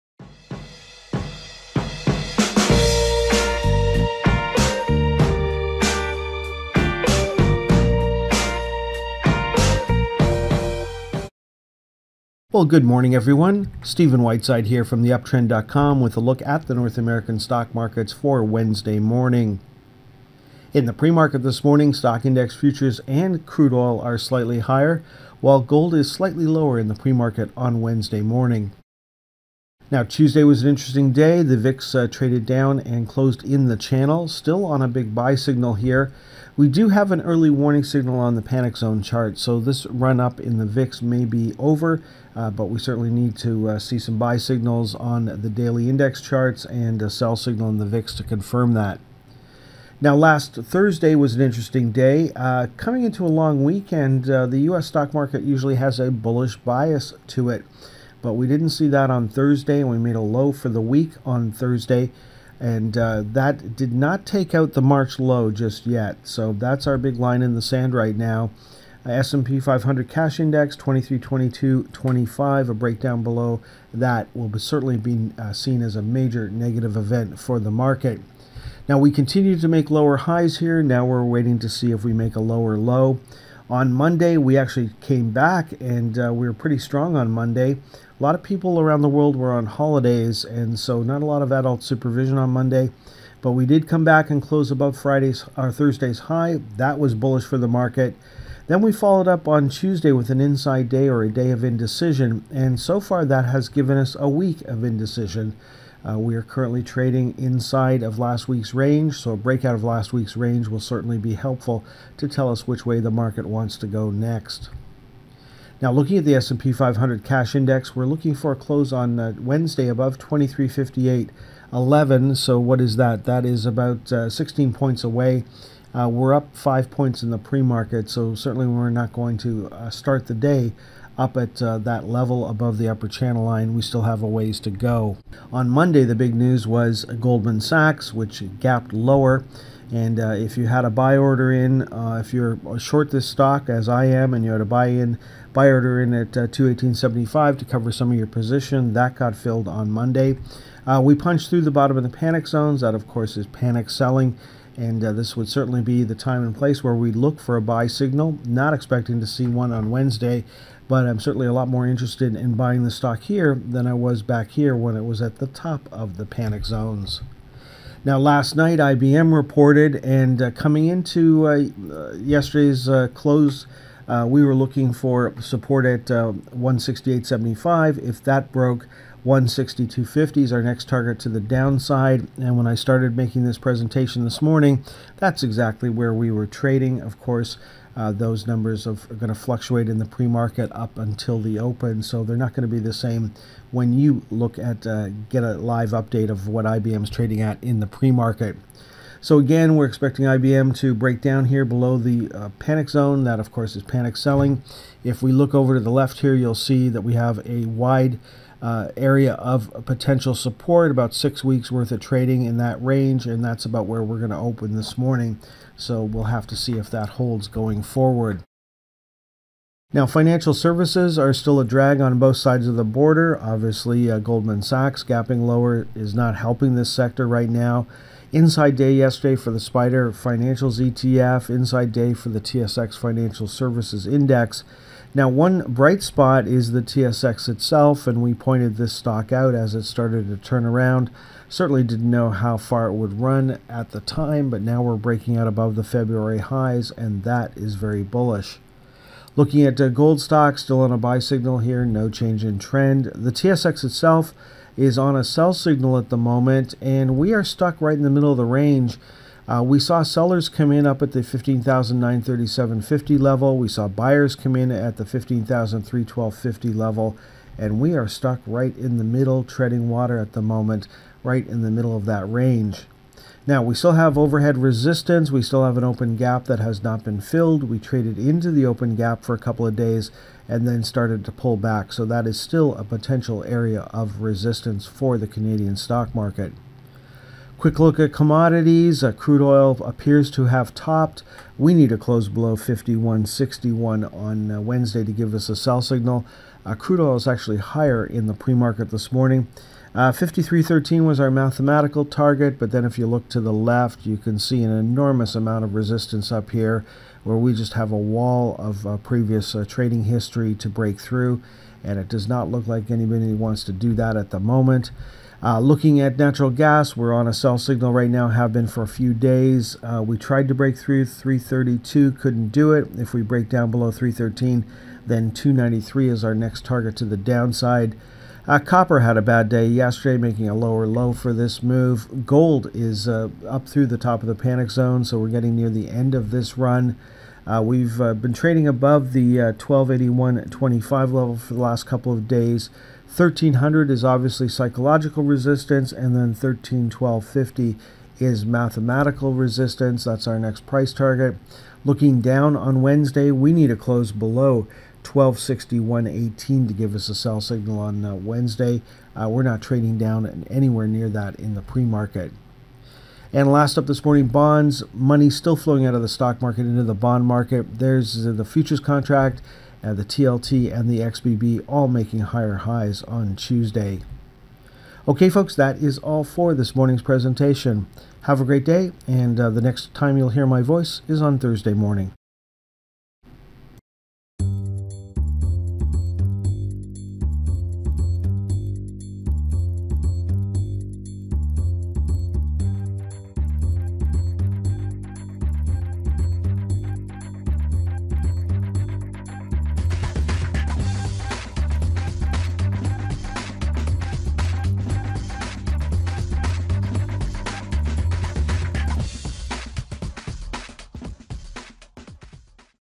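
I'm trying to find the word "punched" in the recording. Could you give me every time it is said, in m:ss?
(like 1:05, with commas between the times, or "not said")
2:31.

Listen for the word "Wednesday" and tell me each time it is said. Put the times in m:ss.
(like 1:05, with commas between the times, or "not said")
0:18, 0:27, 1:59, 2:39, 4:54, 5:52, 5:58.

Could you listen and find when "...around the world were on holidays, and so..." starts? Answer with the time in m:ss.
1:28.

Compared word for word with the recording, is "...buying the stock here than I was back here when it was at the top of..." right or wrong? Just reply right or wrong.
right.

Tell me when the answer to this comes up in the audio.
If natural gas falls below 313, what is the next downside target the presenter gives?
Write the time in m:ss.
5:25.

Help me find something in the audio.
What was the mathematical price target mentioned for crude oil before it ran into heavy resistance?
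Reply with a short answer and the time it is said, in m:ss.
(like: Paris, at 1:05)
53.13, at 5:00.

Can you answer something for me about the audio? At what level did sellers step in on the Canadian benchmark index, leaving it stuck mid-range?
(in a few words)
15,937.50.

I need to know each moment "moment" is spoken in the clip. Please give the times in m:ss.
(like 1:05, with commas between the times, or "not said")
4:16, 4:30, 5:14.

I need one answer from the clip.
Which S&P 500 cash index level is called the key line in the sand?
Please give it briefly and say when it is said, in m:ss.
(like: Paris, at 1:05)
2322.25, at 1:10.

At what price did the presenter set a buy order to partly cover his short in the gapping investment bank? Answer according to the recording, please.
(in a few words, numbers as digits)
218.75.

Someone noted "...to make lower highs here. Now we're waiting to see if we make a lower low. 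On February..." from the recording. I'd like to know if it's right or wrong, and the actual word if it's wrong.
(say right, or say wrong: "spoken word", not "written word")
wrong: "Monday", not "February".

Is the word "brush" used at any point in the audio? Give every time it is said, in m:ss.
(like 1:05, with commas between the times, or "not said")
not said.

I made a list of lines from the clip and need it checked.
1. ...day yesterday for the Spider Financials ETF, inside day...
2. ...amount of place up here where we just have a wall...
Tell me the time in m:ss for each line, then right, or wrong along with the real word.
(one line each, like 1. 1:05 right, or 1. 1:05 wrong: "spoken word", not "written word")
1. 3:48 right
2. 5:05 wrong: "resistance", not "place".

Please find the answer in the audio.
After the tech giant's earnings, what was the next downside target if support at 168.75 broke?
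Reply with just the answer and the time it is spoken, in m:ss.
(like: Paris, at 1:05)
162.50, at 2:59.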